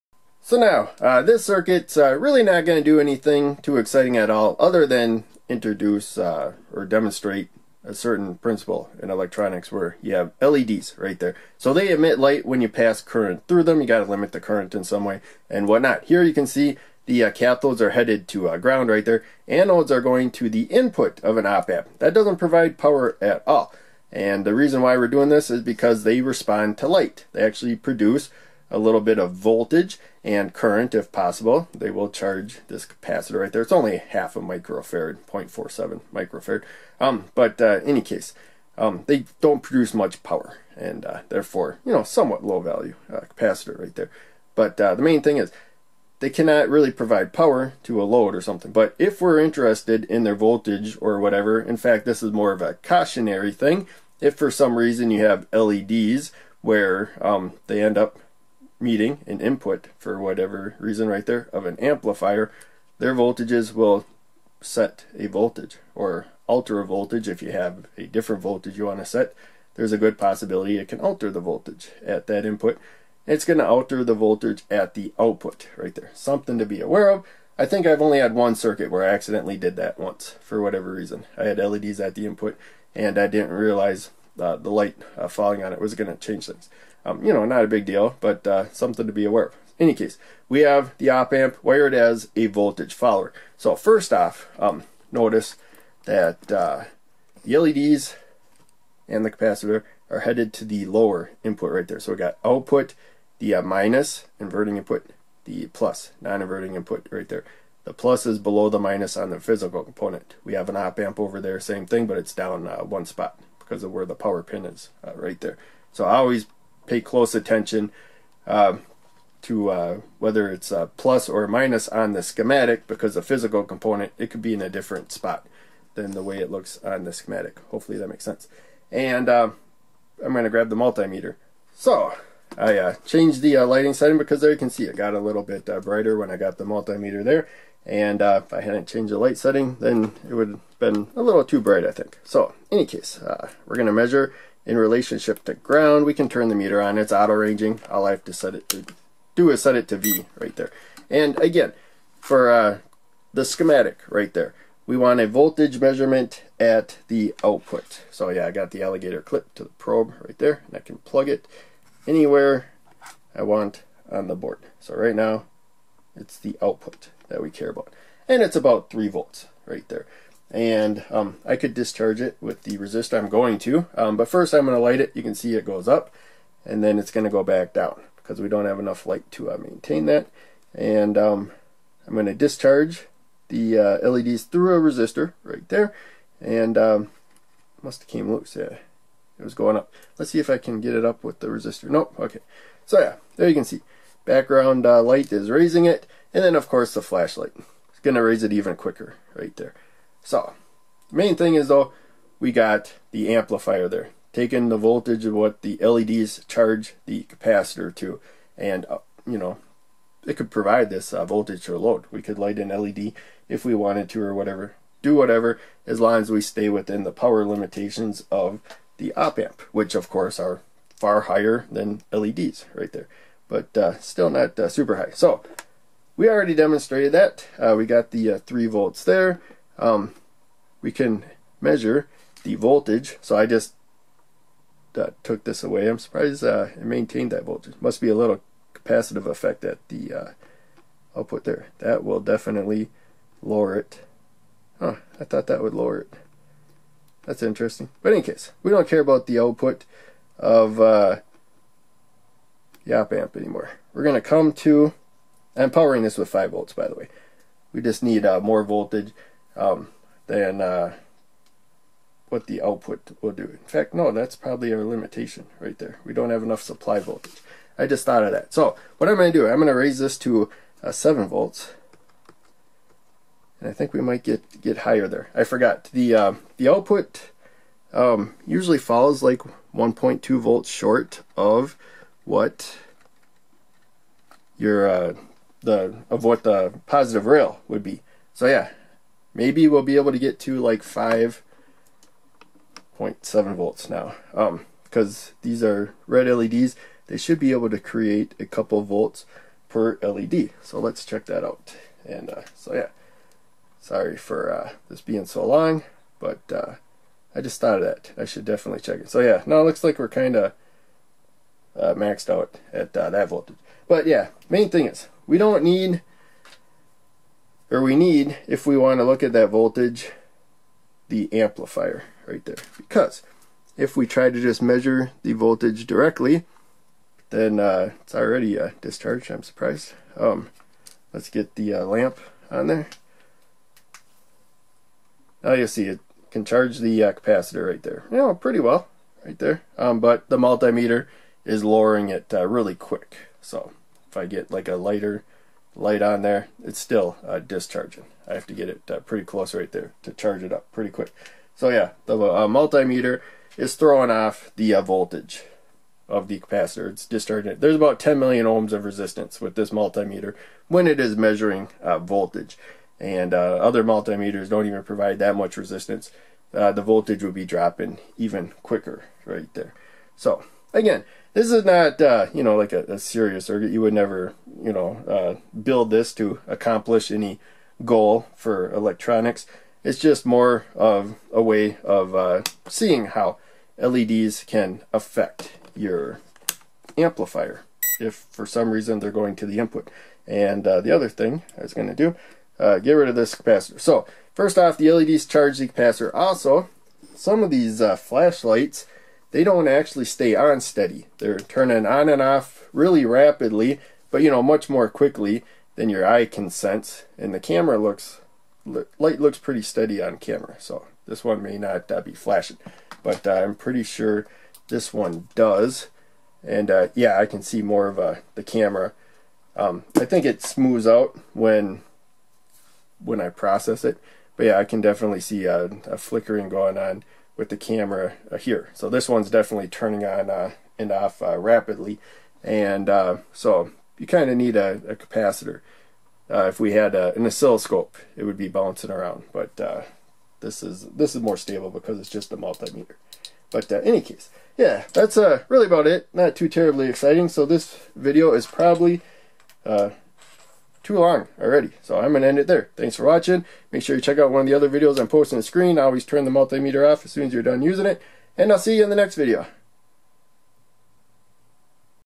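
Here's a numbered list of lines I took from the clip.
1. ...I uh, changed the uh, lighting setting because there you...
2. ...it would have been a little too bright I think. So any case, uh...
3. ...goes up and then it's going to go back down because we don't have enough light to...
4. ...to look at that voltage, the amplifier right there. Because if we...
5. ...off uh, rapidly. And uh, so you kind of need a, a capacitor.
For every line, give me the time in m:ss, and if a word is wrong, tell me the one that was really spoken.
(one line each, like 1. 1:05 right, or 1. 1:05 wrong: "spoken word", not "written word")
1. 2:12 right
2. 2:20 right
3. 2:55 right
4. 5:18 right
5. 7:10 right.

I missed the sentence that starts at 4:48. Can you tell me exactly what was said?
So yeah, maybe we'll be able to get to like 5.7 volts now.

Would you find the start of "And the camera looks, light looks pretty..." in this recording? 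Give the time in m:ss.
6:47.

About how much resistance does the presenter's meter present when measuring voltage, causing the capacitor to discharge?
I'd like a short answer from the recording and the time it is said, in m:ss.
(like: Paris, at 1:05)
10 million ohms, at 5:57.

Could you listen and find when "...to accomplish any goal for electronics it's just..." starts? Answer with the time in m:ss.
6:16.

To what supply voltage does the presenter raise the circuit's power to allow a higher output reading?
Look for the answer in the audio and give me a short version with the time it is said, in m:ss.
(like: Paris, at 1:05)
7 volts, at 4:30.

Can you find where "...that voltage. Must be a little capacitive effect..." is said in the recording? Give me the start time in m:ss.
3:57.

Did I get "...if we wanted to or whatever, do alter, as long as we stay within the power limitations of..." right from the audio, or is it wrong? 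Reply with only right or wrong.
wrong.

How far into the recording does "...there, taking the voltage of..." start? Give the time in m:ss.
3:23.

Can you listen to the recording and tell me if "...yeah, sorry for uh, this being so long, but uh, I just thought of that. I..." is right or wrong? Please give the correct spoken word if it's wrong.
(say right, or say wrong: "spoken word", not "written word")
right.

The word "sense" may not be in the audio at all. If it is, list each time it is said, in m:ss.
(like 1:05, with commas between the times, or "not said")
2:08, 6:46.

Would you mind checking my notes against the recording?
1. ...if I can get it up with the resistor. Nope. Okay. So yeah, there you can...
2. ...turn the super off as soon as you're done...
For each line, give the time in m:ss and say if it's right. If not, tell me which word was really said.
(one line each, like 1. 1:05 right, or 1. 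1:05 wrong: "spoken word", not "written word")
1. 3:10 right
2. 7:36 wrong: "multimeter", not "super".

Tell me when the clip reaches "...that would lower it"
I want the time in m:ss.
4:05.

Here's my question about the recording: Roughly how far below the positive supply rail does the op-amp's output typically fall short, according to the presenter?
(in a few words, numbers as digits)
1.2 volts.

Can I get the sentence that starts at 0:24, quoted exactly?
And the reason why we're doing this is because they respond to light.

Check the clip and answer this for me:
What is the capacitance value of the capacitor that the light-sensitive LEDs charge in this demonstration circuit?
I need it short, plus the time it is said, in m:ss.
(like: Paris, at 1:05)
0.47 microfarad, at 0:35.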